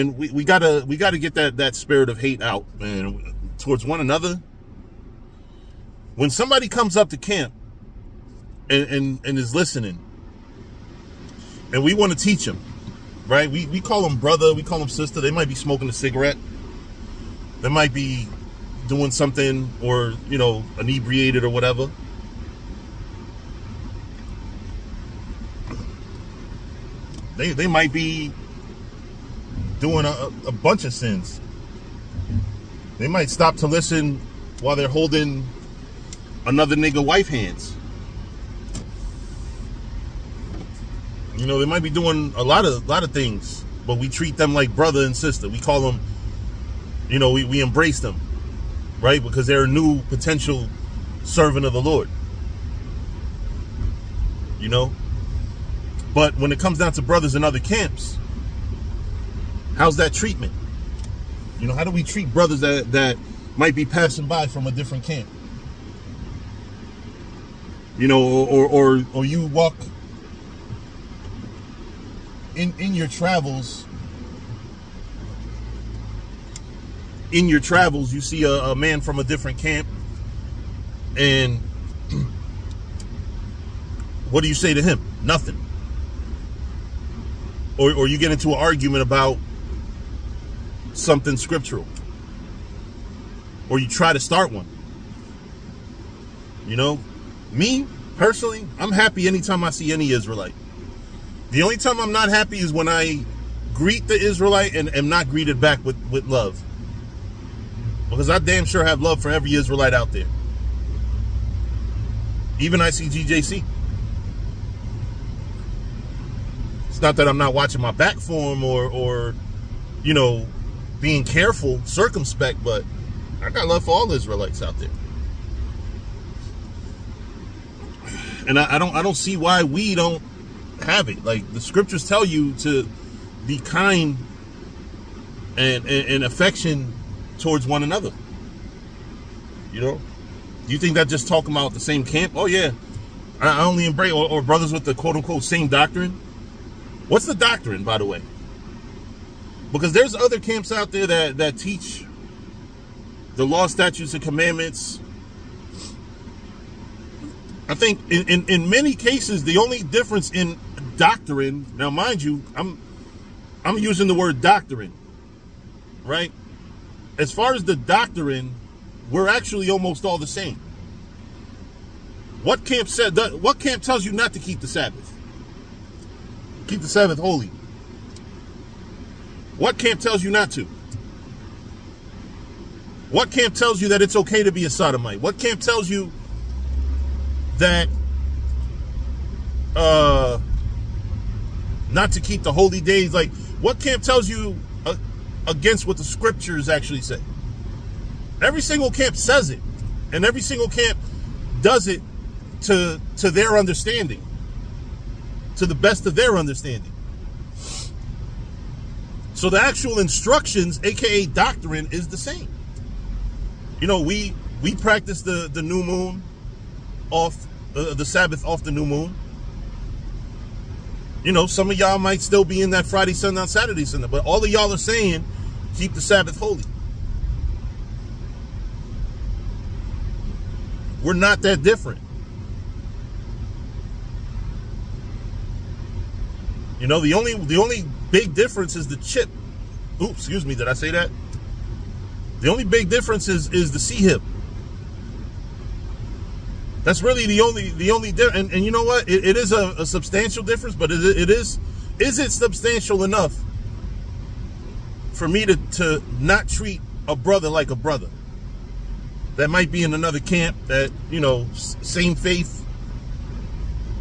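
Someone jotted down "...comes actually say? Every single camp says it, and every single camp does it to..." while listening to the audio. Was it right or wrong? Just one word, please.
wrong.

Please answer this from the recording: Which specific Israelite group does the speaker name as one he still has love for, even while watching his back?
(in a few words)
GJC.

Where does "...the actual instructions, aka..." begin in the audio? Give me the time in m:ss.
3:29.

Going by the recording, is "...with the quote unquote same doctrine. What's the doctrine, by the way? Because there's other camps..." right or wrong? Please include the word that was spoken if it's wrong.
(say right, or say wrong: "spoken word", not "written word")
right.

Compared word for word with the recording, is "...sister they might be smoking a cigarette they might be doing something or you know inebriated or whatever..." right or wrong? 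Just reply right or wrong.
right.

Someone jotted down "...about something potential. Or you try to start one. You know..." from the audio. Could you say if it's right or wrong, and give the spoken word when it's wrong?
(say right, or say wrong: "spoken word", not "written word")
wrong: "scriptural", not "potential".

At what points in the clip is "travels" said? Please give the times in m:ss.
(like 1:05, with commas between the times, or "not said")
1:13, 1:17.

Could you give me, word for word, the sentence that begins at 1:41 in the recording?
The only time I'm not happy is when I greet the Israelite and am not greeted back with, with love.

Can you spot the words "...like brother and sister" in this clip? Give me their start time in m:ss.
0:44.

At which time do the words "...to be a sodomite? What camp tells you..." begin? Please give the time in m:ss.
3:04.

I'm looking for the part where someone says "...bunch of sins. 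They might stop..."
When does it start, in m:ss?
0:30.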